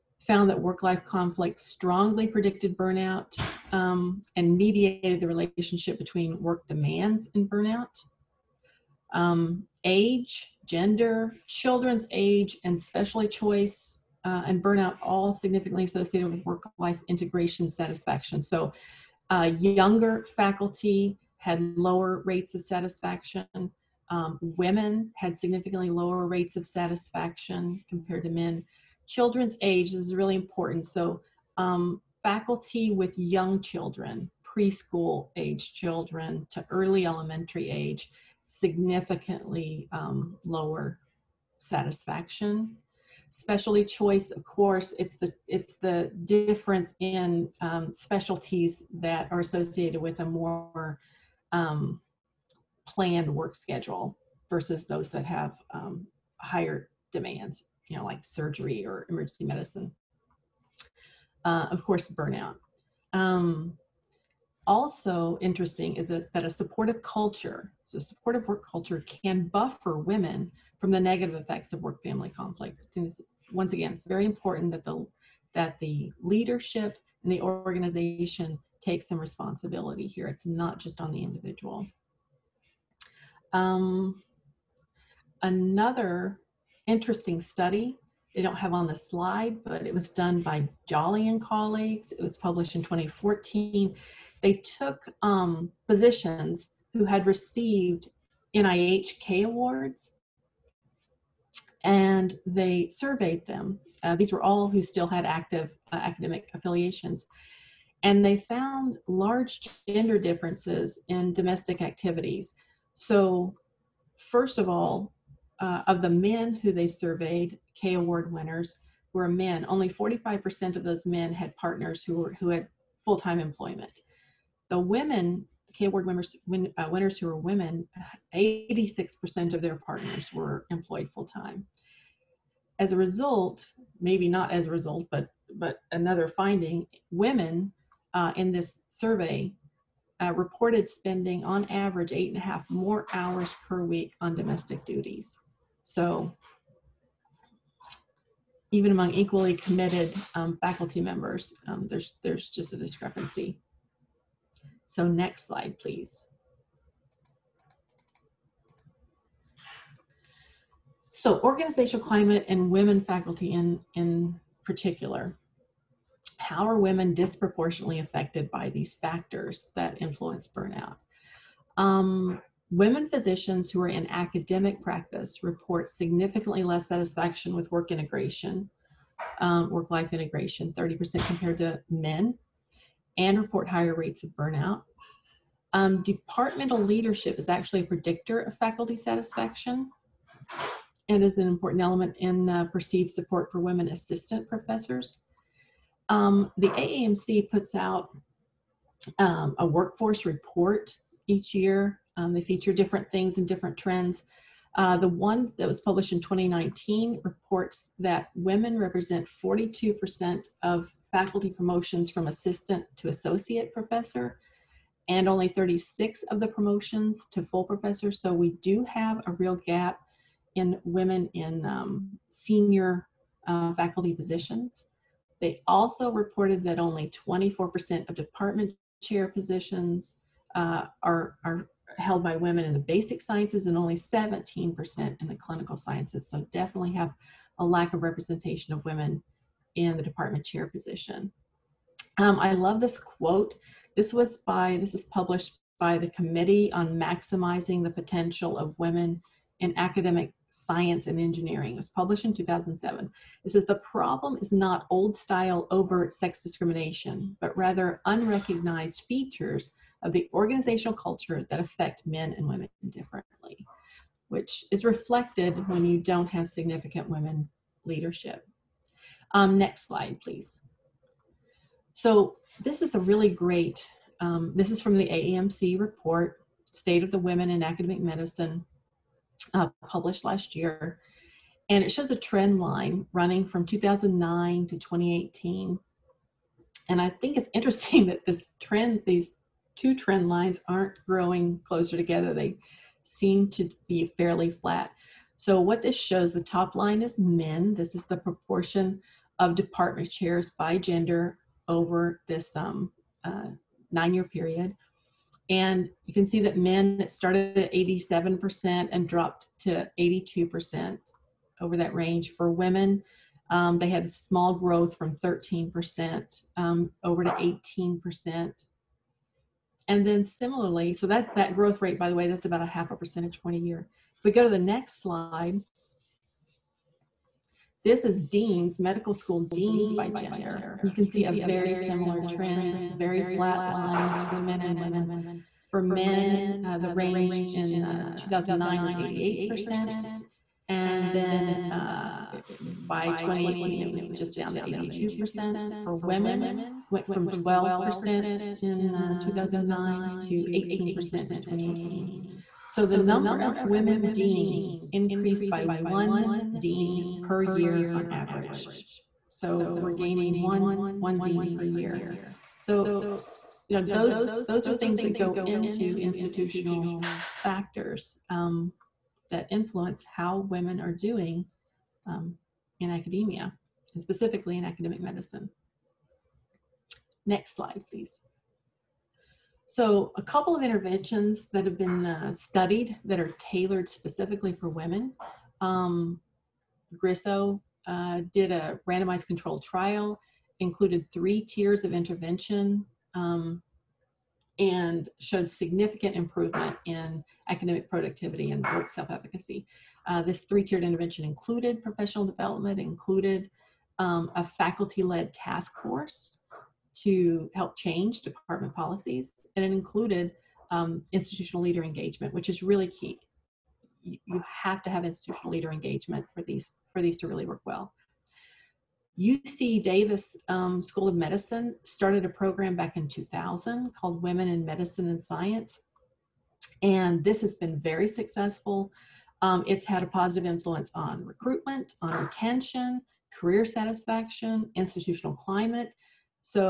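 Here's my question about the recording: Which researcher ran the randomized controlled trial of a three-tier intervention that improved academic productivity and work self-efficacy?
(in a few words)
Grisso.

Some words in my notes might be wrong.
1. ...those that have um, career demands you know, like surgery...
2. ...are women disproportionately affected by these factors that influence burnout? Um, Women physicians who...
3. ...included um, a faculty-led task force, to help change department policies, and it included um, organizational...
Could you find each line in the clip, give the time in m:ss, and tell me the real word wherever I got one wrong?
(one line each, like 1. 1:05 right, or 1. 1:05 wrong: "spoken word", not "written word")
1. 0:54 wrong: "higher", not "career"
2. 2:46 right
3. 6:42 wrong: "institutional", not "organizational".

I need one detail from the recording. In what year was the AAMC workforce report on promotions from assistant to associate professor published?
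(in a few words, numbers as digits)
2019.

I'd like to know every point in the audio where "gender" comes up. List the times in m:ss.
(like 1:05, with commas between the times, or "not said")
0:10, 1:49, 5:00, 5:30.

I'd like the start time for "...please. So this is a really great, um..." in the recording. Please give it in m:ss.
4:30.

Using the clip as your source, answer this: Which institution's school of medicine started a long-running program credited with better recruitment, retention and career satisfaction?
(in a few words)
UC Davis.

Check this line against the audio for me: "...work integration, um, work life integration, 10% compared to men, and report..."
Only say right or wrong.
wrong.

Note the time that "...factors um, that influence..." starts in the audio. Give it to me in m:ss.
6:07.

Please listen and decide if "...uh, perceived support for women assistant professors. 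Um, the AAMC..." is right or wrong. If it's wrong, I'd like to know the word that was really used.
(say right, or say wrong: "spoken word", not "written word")
right.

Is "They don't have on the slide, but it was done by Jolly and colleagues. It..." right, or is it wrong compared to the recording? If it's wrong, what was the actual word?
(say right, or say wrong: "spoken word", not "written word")
right.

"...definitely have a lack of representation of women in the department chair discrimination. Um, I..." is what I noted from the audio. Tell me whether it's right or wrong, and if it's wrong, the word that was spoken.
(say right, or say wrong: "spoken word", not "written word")
wrong: "position", not "discrimination".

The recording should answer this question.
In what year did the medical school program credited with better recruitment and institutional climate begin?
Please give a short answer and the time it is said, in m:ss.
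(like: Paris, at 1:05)
2000, at 7:03.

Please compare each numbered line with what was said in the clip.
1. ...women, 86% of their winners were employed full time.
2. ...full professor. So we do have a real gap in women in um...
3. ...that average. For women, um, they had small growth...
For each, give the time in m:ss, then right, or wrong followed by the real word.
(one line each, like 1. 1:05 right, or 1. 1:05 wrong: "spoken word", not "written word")
1. 2:07 wrong: "partners", not "winners"
2. 3:37 right
3. 5:11 wrong: "range", not "average".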